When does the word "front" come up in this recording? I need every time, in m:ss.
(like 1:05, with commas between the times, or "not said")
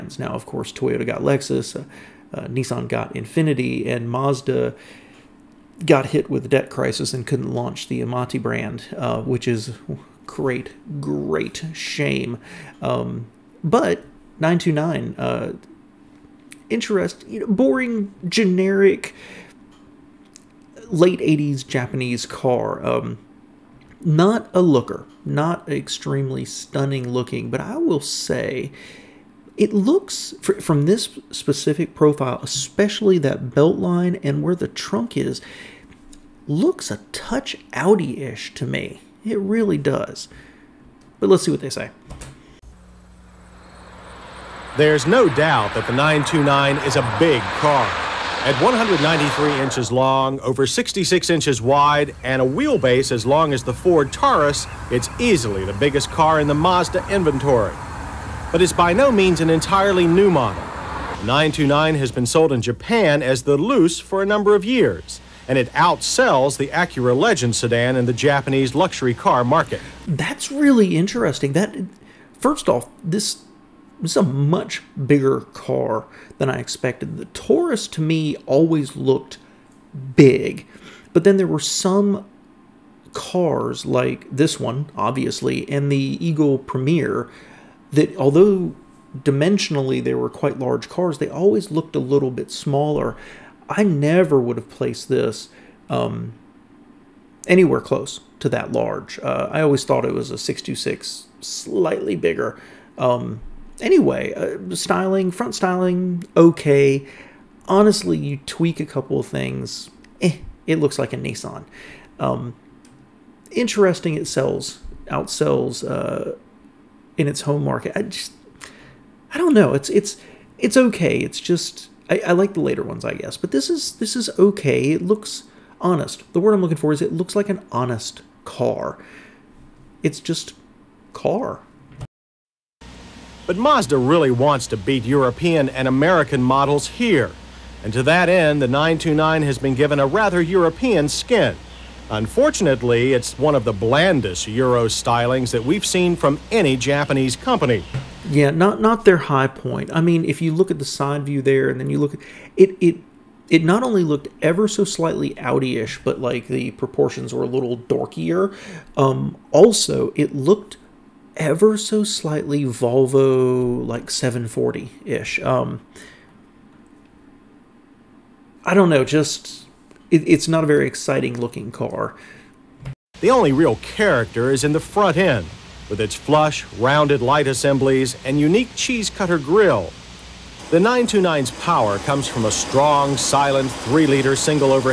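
1:45, 2:54.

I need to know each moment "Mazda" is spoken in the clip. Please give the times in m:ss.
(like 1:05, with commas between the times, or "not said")
0:04, 0:56, 2:13.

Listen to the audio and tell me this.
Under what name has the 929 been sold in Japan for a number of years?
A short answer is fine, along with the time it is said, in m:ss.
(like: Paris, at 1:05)
Luce, at 1:03.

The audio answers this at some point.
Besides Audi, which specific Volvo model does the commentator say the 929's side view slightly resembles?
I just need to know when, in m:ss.
2:44.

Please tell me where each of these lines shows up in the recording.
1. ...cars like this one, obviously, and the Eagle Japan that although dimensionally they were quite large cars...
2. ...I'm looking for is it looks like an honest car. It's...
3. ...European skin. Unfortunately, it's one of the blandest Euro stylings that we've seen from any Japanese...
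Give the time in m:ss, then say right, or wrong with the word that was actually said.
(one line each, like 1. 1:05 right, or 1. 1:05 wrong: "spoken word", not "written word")
1. 1:23 wrong: "Premier", not "Japan"
2. 2:06 right
3. 2:20 right.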